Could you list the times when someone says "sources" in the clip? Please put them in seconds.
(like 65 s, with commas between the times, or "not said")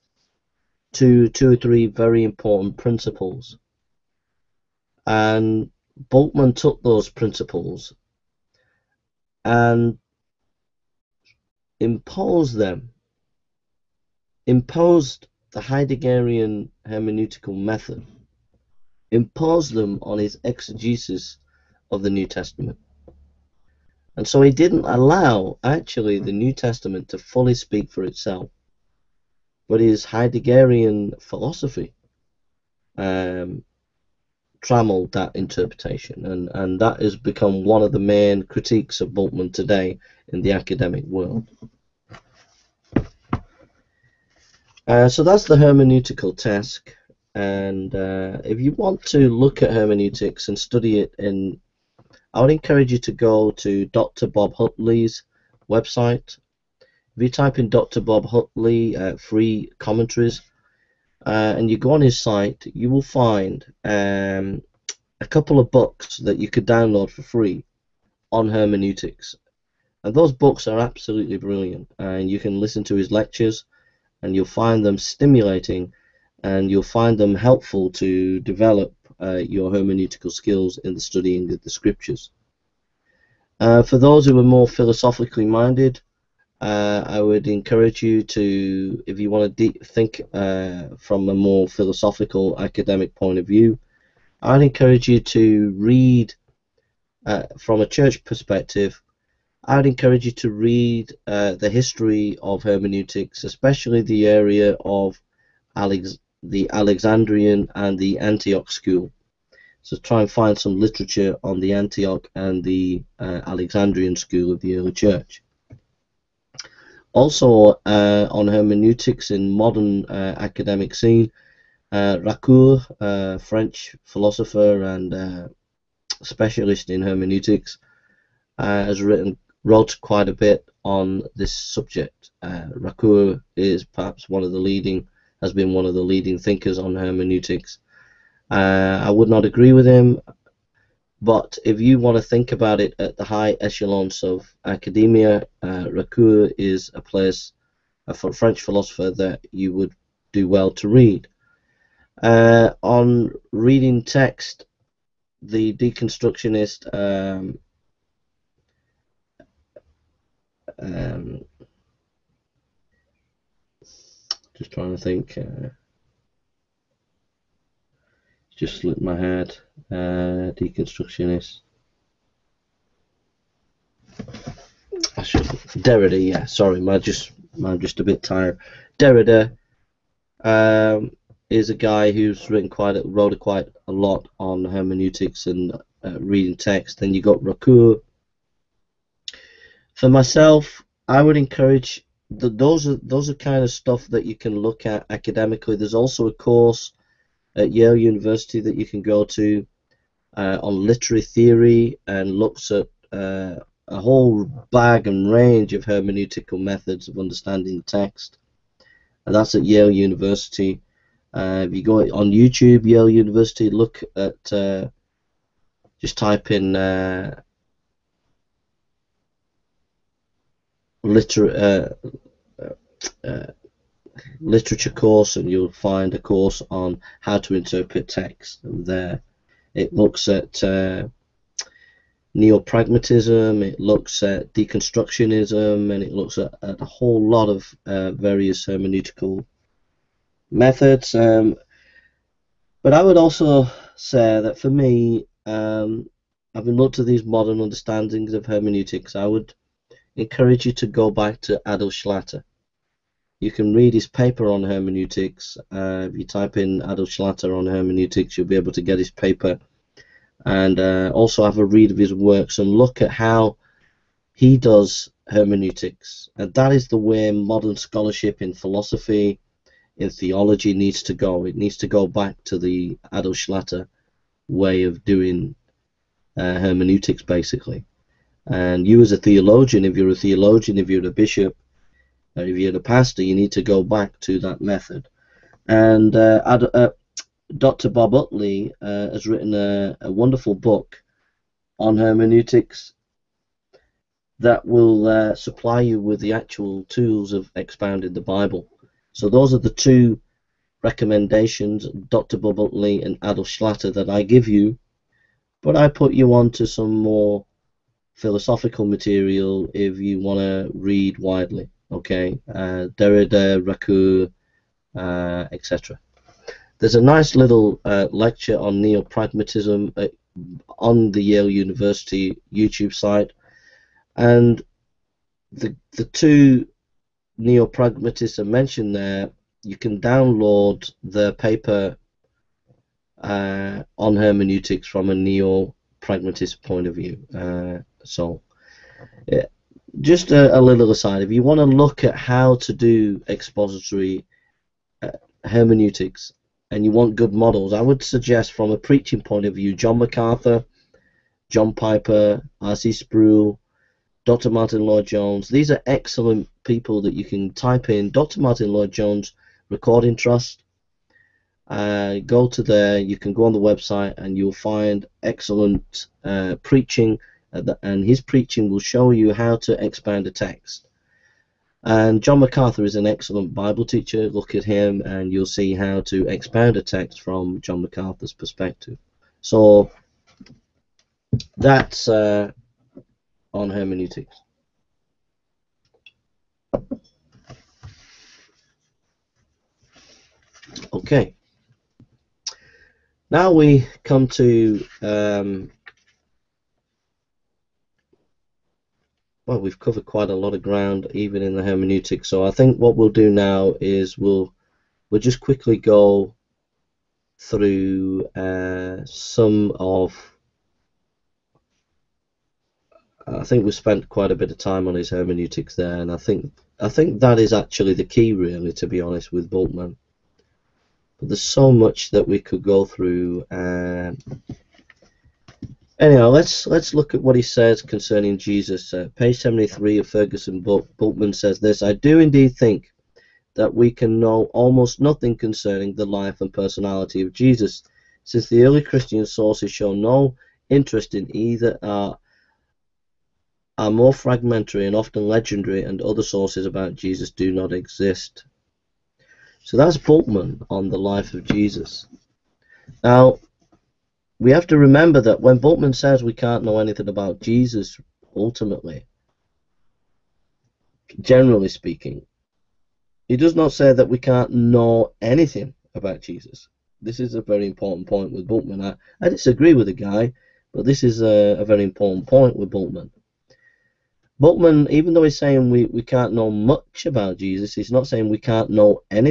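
439 s, 446 s.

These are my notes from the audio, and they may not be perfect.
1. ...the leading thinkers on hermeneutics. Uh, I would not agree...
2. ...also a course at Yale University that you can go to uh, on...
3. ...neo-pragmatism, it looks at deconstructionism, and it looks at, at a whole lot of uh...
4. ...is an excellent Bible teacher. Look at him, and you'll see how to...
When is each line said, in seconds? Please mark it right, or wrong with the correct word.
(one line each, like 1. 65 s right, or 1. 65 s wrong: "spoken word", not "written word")
1. 135 s right
2. 195 s right
3. 232 s right
4. 372 s right.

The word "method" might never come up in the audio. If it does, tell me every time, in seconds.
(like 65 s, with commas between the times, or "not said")
17 s, 206 s, 240 s, 284 s.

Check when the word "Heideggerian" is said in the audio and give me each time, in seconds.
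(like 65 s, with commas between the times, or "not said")
15 s, 30 s.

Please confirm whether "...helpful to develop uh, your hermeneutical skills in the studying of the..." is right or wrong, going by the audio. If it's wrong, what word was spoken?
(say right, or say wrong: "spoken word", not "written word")
right.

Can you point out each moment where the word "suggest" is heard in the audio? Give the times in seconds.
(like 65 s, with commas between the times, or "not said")
348 s.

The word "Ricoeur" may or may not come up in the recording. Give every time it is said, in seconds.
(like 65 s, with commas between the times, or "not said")
122 s, 132 s, 145 s, 187 s, 313 s.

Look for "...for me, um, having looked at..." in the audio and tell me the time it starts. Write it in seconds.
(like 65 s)
244 s.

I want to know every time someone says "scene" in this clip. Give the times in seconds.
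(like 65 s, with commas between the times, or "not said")
120 s.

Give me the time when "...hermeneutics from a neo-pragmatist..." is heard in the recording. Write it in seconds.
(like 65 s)
334 s.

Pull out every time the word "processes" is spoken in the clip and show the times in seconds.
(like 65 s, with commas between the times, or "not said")
not said.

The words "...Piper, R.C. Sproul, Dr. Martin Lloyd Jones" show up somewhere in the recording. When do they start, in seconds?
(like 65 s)
351 s.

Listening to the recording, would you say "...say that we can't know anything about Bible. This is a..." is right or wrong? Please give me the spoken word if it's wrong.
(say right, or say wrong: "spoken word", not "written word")
wrong: "Jesus", not "Bible".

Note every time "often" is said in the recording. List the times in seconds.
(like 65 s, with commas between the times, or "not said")
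444 s.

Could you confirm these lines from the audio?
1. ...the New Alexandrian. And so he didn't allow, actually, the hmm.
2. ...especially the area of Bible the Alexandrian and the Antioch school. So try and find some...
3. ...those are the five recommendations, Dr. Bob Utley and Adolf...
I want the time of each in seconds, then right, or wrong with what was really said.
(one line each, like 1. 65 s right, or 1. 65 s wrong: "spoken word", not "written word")
1. 22 s wrong: "Testament", not "Alexandrian"
2. 103 s wrong: "Alex", not "Bible"
3. 299 s wrong: "two", not "five".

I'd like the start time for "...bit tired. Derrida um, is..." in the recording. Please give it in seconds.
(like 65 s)
178 s.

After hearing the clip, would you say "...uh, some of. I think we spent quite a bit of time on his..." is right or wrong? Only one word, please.
right.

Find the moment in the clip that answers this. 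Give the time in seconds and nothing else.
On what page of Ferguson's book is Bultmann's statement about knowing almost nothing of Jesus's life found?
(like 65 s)
429 s.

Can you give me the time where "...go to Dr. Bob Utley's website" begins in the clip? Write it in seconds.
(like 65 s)
53 s.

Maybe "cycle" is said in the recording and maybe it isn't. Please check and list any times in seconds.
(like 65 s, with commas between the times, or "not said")
not said.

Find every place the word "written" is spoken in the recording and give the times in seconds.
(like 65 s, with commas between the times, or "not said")
129 s, 182 s, 289 s.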